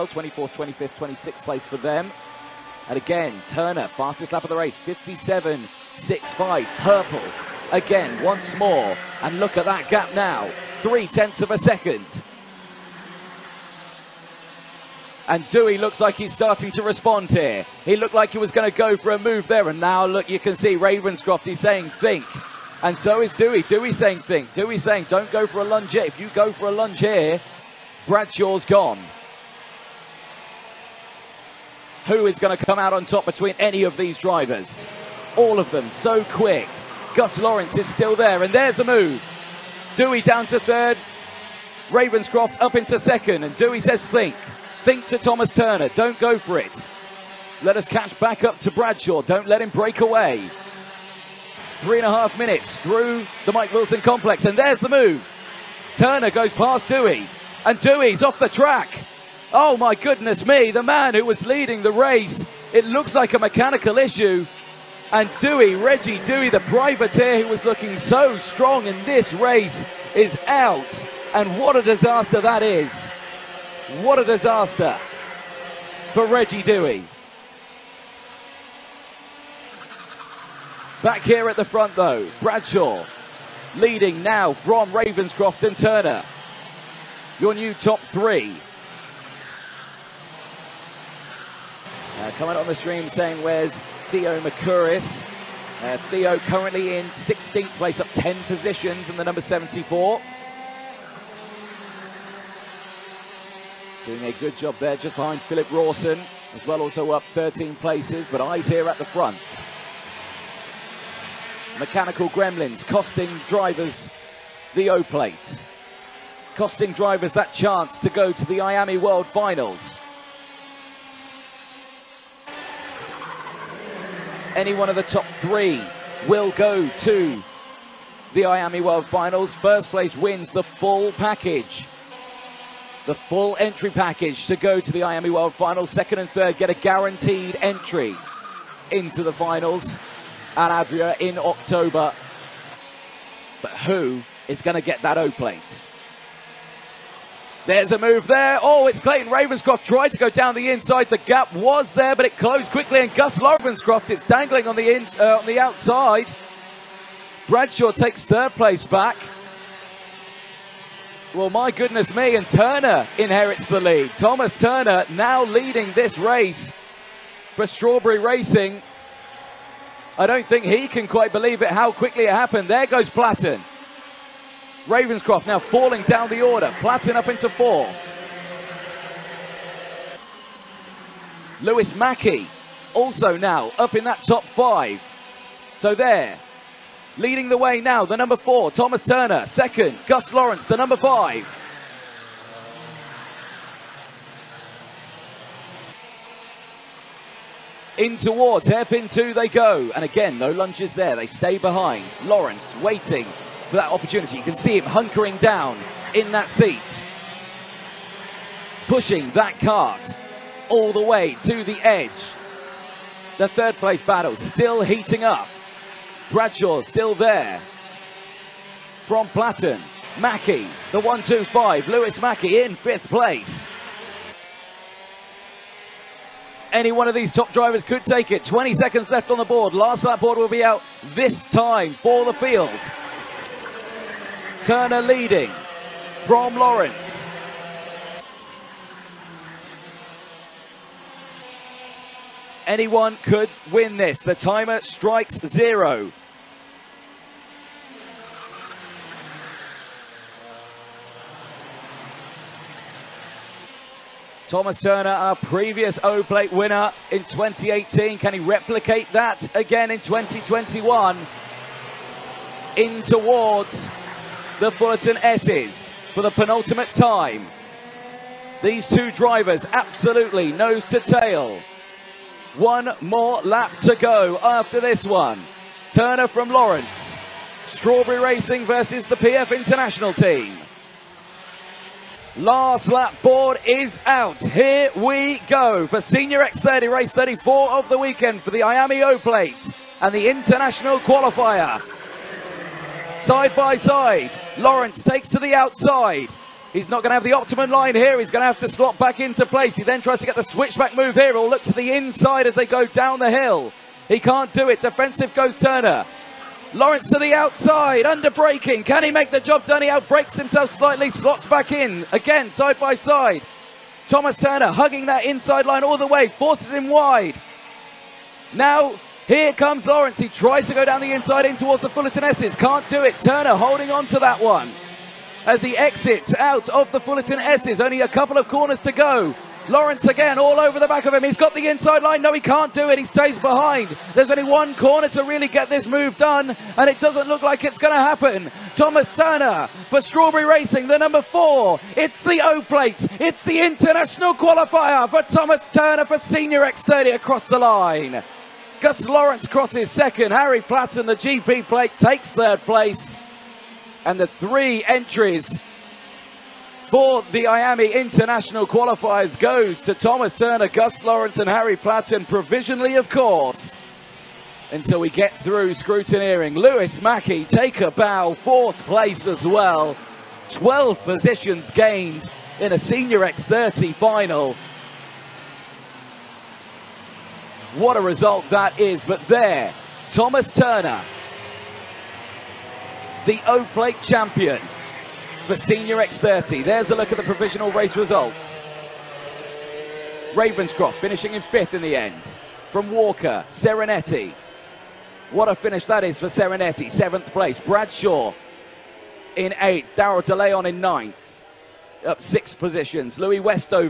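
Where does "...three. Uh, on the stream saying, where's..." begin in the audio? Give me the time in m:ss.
1:27.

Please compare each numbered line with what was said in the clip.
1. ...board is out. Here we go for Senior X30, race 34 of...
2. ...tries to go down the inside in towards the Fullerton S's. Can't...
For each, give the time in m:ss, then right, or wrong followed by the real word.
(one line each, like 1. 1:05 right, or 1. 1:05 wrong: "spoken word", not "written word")
1. 4:43 right
2. 5:20 right.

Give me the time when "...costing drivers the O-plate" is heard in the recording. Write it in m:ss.
1:52.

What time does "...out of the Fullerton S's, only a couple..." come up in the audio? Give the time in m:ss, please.
5:26.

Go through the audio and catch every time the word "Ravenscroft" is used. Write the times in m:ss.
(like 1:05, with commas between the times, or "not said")
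0:20, 0:41, 1:24, 2:29, 2:33, 2:54, 6:30.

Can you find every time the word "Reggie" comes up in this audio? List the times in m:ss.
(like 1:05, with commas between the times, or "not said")
1:05, 1:16.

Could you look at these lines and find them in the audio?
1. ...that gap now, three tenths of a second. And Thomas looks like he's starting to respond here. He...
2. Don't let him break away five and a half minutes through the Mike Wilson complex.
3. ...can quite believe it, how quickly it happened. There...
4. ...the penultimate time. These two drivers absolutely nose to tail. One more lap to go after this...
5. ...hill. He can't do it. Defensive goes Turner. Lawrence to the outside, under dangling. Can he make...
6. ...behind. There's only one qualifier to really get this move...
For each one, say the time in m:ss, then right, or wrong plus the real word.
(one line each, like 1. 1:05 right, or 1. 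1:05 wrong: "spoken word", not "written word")
1. 0:09 wrong: "Dewey", not "Thomas"
2. 0:49 wrong: "three", not "five"
3. 2:50 right
4. 4:26 right
5. 5:03 wrong: "braking", not "dangling"
6. 5:33 wrong: "corner", not "qualifier".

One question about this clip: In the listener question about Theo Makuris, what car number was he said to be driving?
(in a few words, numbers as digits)
74.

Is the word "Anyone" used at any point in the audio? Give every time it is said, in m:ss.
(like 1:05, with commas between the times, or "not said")
4:02.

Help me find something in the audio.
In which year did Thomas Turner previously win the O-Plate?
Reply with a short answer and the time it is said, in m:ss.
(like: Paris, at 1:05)
2018, at 4:17.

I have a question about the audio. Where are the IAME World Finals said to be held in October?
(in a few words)
Al Adria.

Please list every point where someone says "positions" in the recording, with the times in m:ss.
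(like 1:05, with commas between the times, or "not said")
1:38, 6:11, 6:42.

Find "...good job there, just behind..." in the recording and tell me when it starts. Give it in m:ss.
1:44.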